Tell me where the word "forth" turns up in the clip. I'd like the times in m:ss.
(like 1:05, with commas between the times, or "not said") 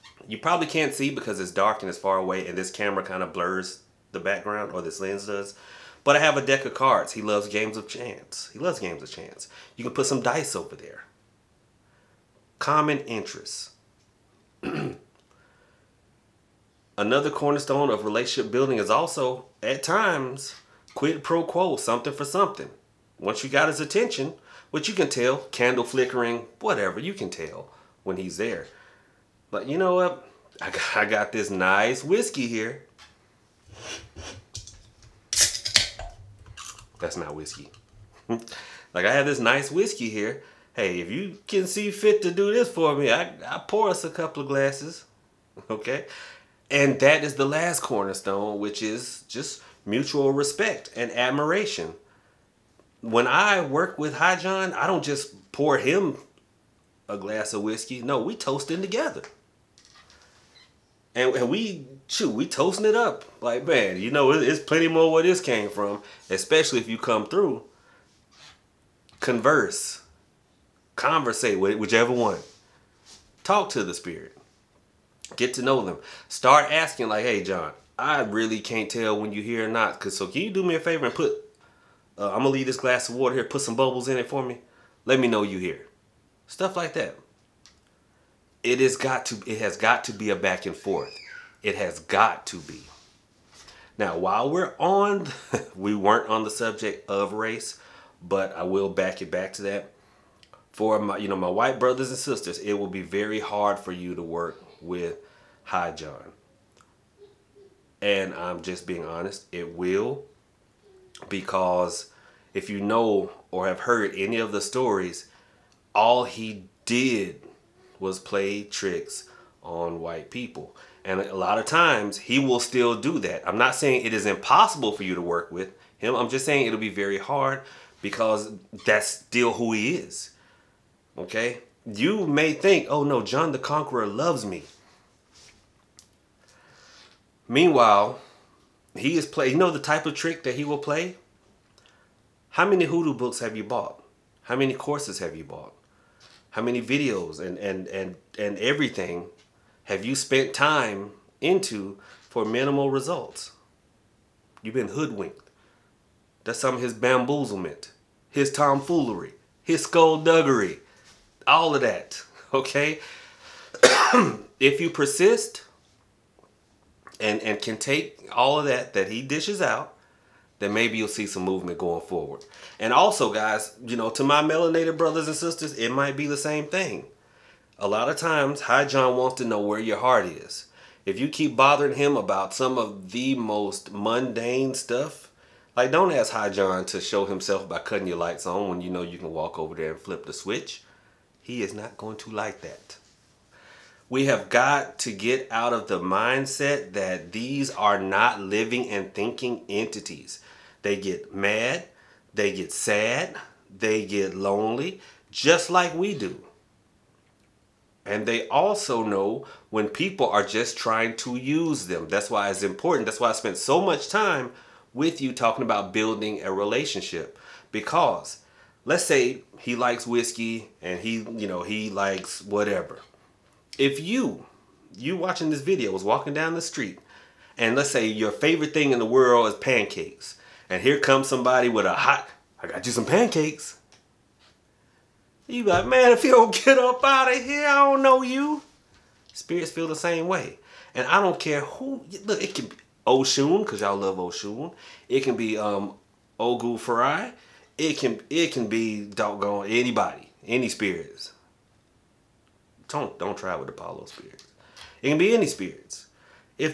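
1:30.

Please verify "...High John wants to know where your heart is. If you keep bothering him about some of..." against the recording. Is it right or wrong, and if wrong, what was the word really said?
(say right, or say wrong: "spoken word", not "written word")
right.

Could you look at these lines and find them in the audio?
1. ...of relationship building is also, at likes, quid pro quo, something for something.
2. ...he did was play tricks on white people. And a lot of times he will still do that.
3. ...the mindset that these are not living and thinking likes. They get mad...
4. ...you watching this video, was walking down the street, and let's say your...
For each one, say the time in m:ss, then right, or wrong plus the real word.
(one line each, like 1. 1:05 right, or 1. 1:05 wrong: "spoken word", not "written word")
1. 0:17 wrong: "times", not "likes"
2. 1:56 right
3. 3:15 wrong: "entities", not "likes"
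4. 3:44 right.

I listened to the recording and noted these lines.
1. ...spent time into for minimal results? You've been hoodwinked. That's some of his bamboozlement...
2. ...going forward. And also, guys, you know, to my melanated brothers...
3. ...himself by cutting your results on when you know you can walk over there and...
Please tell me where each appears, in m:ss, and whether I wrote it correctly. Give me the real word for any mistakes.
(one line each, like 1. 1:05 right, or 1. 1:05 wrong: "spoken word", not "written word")
1. 2:30 right
2. 2:51 right
3. 3:07 wrong: "lights", not "results".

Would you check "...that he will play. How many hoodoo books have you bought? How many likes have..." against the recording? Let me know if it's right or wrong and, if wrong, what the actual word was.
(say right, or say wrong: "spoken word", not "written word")
wrong: "courses", not "likes".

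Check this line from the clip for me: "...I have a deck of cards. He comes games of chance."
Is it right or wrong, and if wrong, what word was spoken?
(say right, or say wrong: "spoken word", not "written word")
wrong: "loves", not "comes".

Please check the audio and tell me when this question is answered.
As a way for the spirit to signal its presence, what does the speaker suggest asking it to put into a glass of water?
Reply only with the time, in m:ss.
1:23.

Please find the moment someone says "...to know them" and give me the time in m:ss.
1:15.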